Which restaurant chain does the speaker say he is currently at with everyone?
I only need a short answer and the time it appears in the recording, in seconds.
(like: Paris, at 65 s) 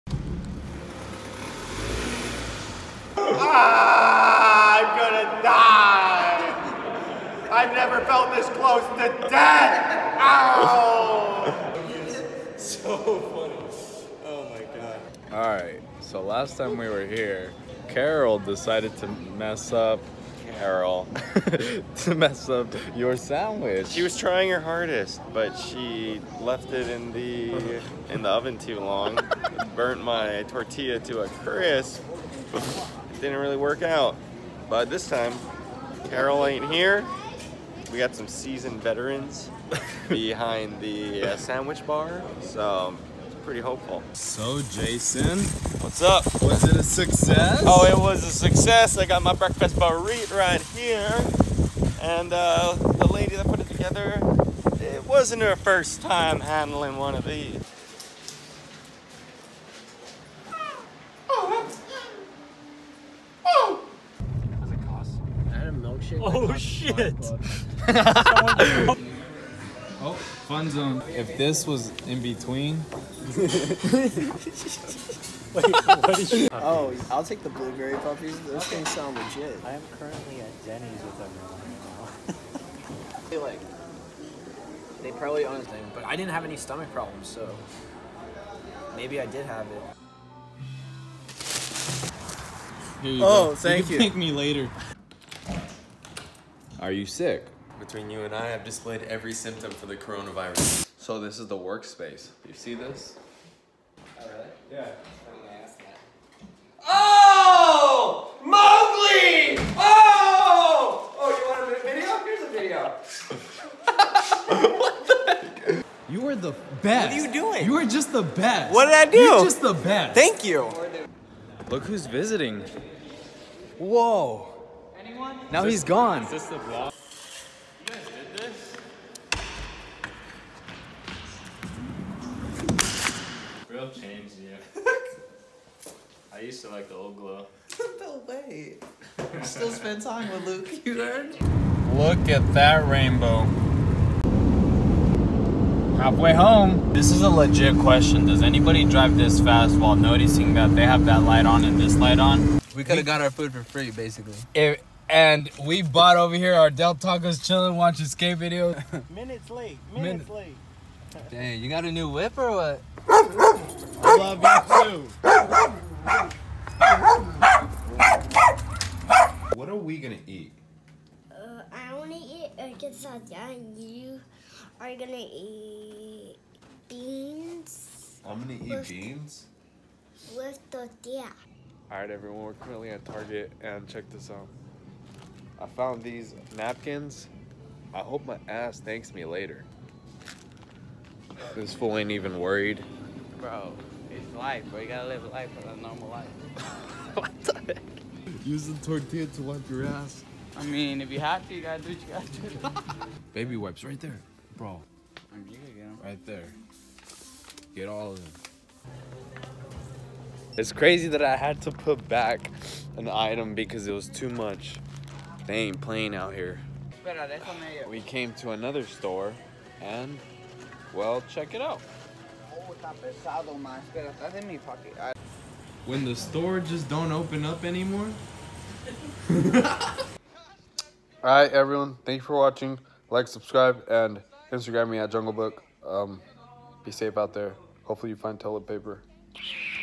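Denny's, at 80 s.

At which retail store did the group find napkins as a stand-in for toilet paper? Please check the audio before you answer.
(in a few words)
Target.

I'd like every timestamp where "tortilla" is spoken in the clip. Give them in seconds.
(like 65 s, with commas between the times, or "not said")
30 s, 180 s, 198 s.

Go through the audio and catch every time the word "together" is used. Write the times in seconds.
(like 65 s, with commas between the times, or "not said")
53 s.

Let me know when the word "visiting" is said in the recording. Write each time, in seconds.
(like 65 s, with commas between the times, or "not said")
122 s.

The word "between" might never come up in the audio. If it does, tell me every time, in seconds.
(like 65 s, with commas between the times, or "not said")
72 s, 97 s.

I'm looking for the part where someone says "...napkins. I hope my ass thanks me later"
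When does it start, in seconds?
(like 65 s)
186 s.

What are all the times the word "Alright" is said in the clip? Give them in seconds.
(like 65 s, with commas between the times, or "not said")
181 s, 231 s.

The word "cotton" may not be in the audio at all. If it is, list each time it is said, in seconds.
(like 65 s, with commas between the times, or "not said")
not said.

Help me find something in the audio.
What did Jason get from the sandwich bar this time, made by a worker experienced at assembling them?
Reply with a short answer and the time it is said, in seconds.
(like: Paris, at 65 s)
Breakfast burrito, at 49 s.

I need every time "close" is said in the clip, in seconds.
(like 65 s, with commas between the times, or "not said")
8 s.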